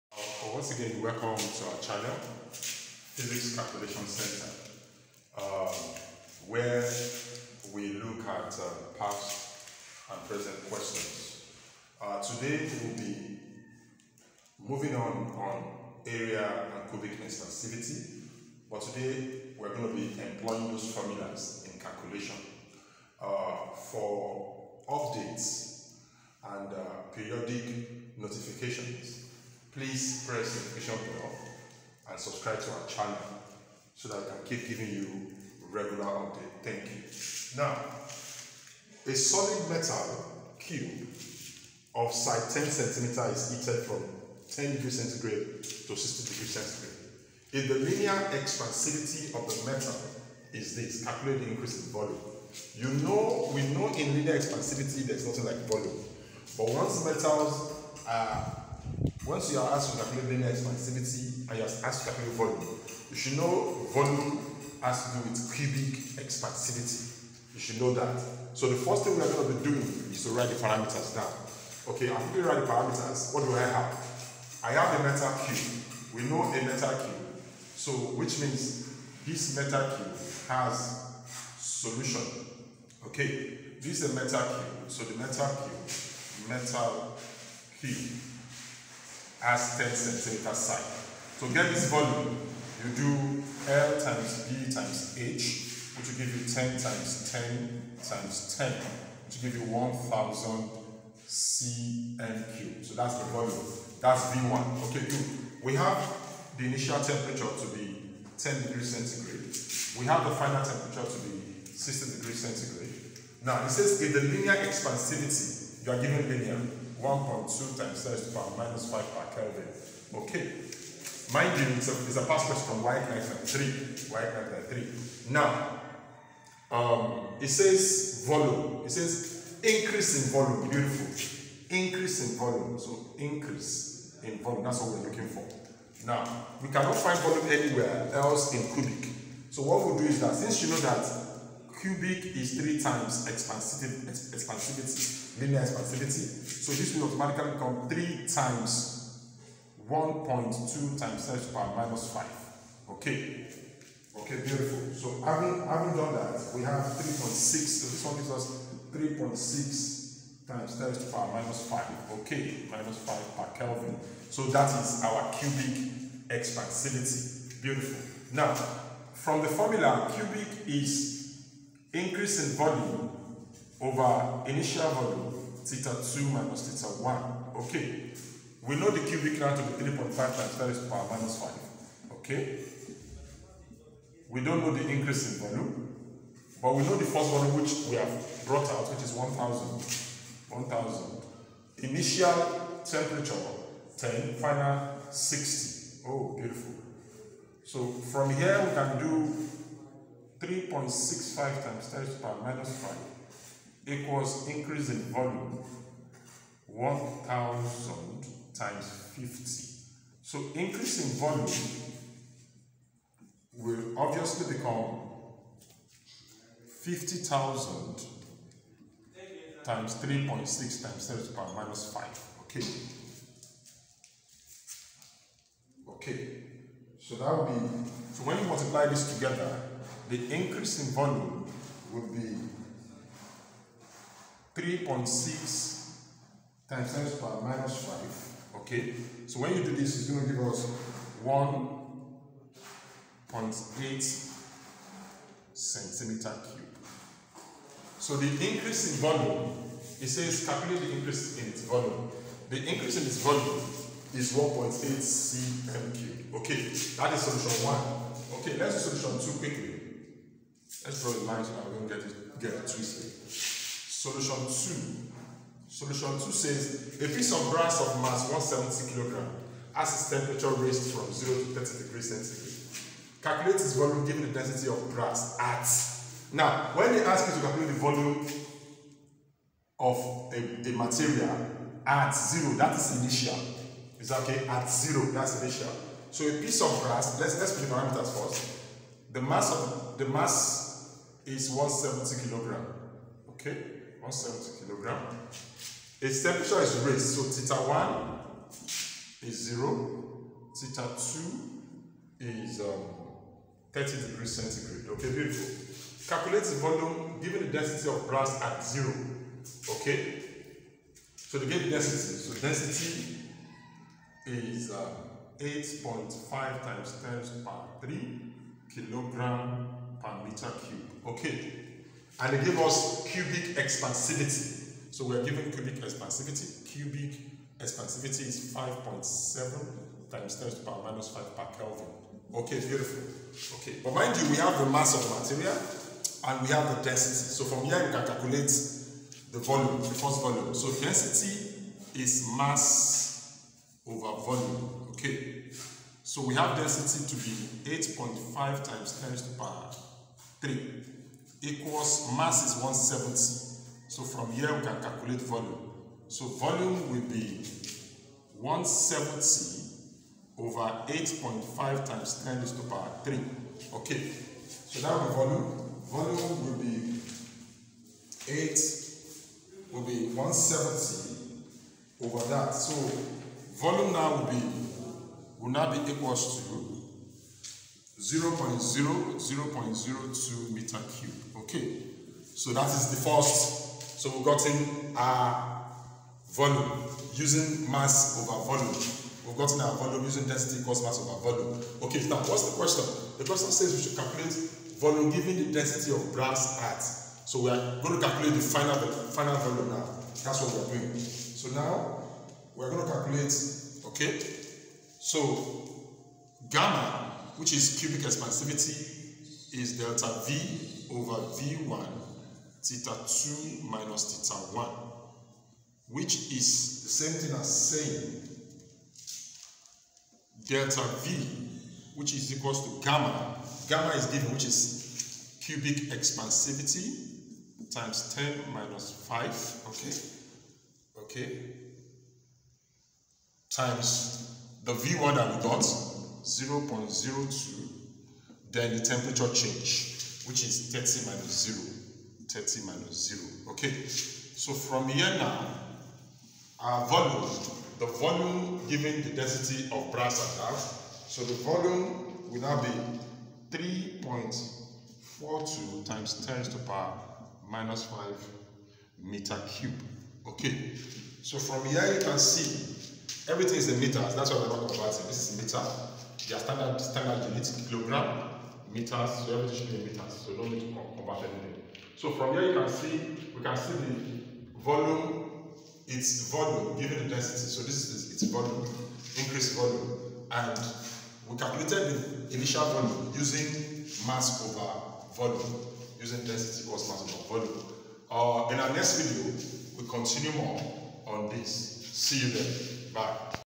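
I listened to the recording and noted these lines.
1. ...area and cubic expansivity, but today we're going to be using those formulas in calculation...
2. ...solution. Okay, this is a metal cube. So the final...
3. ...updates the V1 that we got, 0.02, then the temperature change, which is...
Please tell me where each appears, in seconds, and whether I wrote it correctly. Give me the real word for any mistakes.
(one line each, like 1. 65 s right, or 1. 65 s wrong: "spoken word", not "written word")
1. 16 s wrong: "employing", not "using"
2. 81 s wrong: "metal", not "final"
3. 433 s wrong: "times", not "updates".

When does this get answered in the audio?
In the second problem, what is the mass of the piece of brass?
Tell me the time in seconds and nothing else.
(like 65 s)
268 s.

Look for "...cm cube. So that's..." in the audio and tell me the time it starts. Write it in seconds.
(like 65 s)
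101 s.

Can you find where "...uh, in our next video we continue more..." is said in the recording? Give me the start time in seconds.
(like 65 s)
488 s.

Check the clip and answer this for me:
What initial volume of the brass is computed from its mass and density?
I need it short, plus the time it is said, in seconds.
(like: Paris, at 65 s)
0.02 m³, at 379 s.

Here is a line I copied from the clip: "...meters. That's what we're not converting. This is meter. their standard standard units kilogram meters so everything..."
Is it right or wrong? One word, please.
right.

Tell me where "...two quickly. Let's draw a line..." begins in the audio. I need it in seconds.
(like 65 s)
259 s.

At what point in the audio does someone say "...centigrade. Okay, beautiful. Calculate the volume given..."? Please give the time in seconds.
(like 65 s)
304 s.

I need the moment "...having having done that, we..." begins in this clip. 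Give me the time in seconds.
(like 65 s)
155 s.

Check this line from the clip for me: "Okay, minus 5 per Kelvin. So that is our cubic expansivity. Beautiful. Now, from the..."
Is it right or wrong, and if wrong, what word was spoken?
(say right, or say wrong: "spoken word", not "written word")
right.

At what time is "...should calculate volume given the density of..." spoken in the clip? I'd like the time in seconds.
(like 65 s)
393 s.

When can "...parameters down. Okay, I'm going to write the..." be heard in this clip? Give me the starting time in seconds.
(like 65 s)
70 s.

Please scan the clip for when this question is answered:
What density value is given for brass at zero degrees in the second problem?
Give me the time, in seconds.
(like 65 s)
315 s.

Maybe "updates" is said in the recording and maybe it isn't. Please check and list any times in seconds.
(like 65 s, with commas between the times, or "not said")
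24 s, 36 s.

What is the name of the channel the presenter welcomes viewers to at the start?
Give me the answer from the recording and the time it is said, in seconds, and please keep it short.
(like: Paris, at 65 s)
Physics Calculation Center, at 2 s.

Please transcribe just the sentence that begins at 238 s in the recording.
Okay, so when you do this, it's going to give us 1.8 centimeter cube.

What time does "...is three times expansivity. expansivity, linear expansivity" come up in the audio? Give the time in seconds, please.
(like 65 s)
142 s.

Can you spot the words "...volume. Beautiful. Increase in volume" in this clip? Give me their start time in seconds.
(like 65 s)
130 s.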